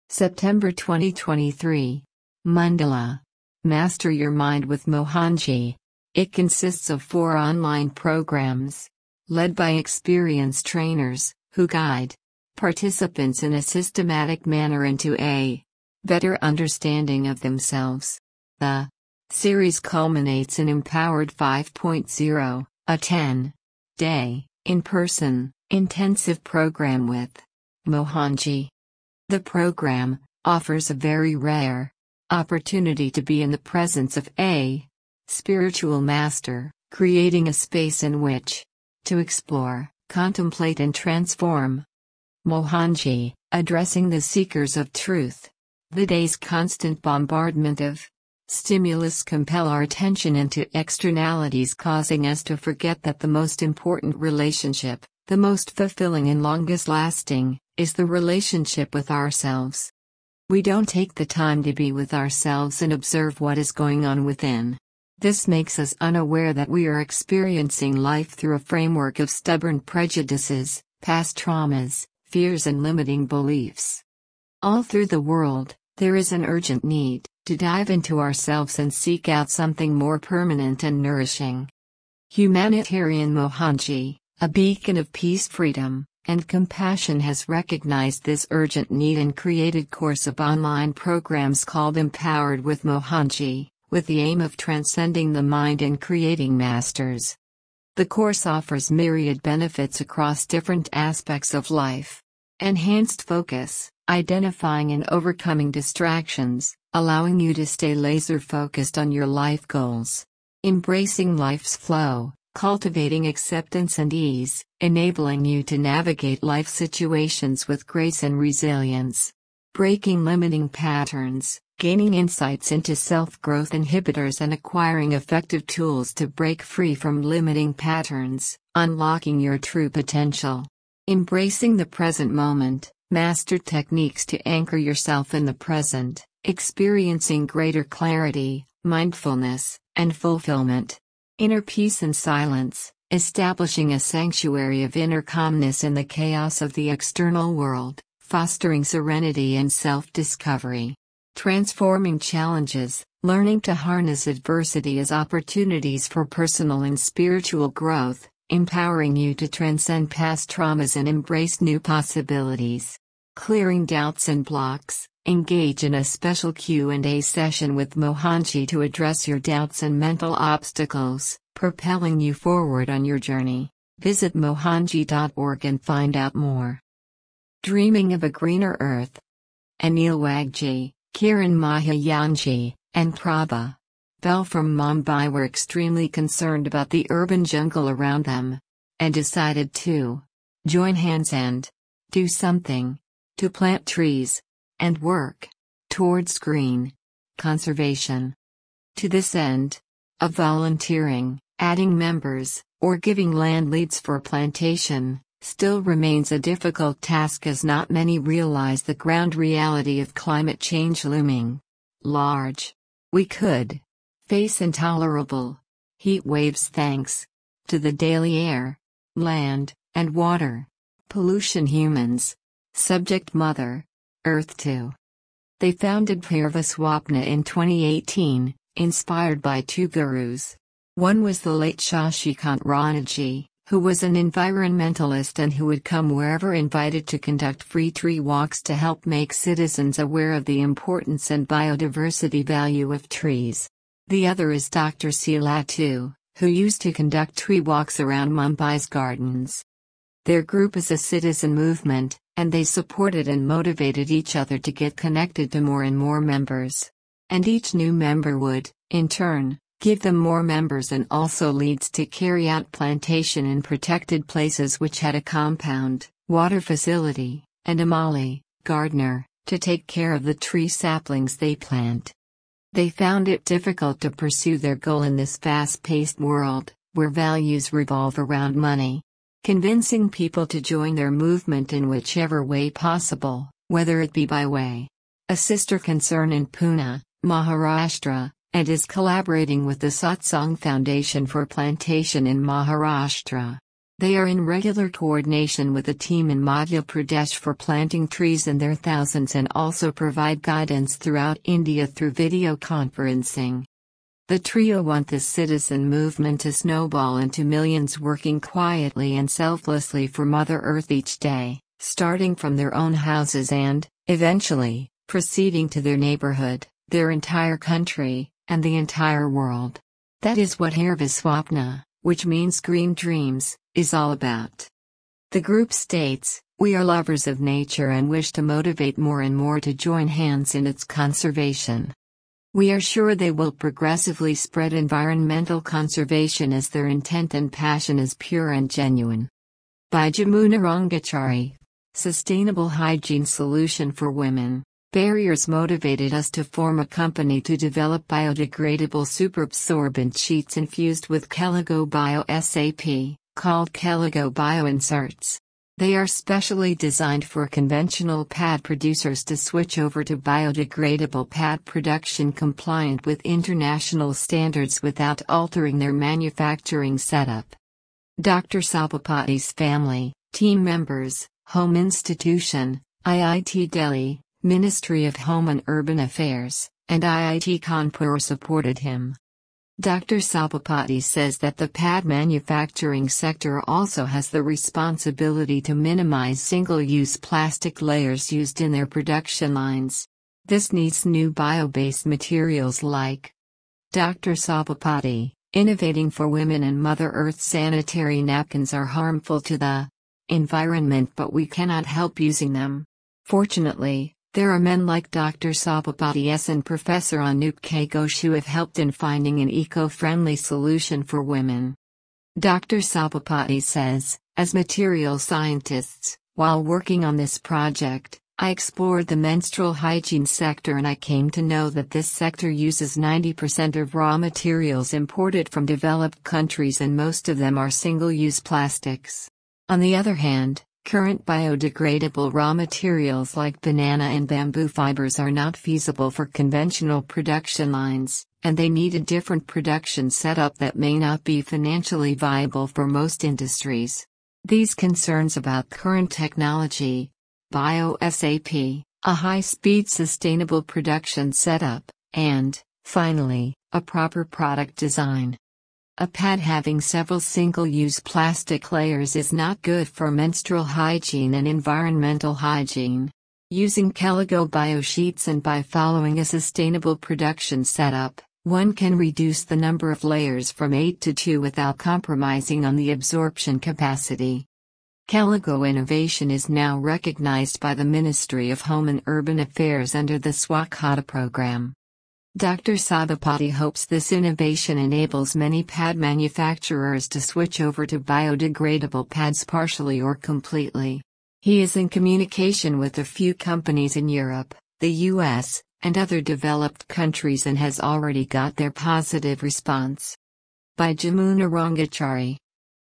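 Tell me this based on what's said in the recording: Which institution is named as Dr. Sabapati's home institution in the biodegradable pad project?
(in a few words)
IIT Delhi.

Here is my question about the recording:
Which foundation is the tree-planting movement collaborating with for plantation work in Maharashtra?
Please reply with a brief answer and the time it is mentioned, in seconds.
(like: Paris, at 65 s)
Satsang Foundation, at 289 s.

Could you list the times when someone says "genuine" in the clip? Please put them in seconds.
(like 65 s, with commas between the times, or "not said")
338 s.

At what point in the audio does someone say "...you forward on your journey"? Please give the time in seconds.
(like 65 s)
172 s.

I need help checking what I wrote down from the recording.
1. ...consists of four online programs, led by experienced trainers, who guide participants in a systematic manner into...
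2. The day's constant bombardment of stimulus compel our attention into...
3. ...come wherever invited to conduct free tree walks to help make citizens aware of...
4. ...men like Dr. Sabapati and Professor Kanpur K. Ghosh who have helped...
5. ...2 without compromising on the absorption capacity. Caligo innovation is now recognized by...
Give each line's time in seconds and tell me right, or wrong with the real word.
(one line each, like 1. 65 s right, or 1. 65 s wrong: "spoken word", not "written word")
1. 6 s right
2. 45 s right
3. 235 s right
4. 404 s wrong: "Anup", not "Kanpur"
5. 471 s right.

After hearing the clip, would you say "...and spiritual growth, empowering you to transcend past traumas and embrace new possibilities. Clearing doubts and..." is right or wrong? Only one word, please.
right.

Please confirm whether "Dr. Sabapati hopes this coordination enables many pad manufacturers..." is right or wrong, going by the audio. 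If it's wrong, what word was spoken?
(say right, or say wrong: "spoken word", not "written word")
wrong: "innovation", not "coordination".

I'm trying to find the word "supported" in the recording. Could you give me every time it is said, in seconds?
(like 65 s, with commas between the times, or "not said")
252 s, 378 s.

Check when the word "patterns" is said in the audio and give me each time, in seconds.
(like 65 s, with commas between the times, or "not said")
120 s, 127 s.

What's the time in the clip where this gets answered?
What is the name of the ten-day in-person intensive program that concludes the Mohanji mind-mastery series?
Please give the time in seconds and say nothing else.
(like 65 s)
20 s.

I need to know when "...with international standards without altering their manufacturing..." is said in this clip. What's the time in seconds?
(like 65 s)
363 s.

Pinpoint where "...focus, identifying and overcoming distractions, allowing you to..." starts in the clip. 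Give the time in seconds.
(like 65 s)
103 s.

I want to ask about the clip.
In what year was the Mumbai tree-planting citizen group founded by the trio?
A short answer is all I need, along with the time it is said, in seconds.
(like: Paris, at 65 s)
2018, at 227 s.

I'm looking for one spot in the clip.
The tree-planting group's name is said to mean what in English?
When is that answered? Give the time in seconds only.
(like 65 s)
322 s.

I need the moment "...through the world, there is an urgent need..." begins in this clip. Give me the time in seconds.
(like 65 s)
74 s.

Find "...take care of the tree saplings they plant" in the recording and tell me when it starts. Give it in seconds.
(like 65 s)
269 s.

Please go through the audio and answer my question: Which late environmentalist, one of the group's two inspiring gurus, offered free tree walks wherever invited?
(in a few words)
Shashikant Ranaji.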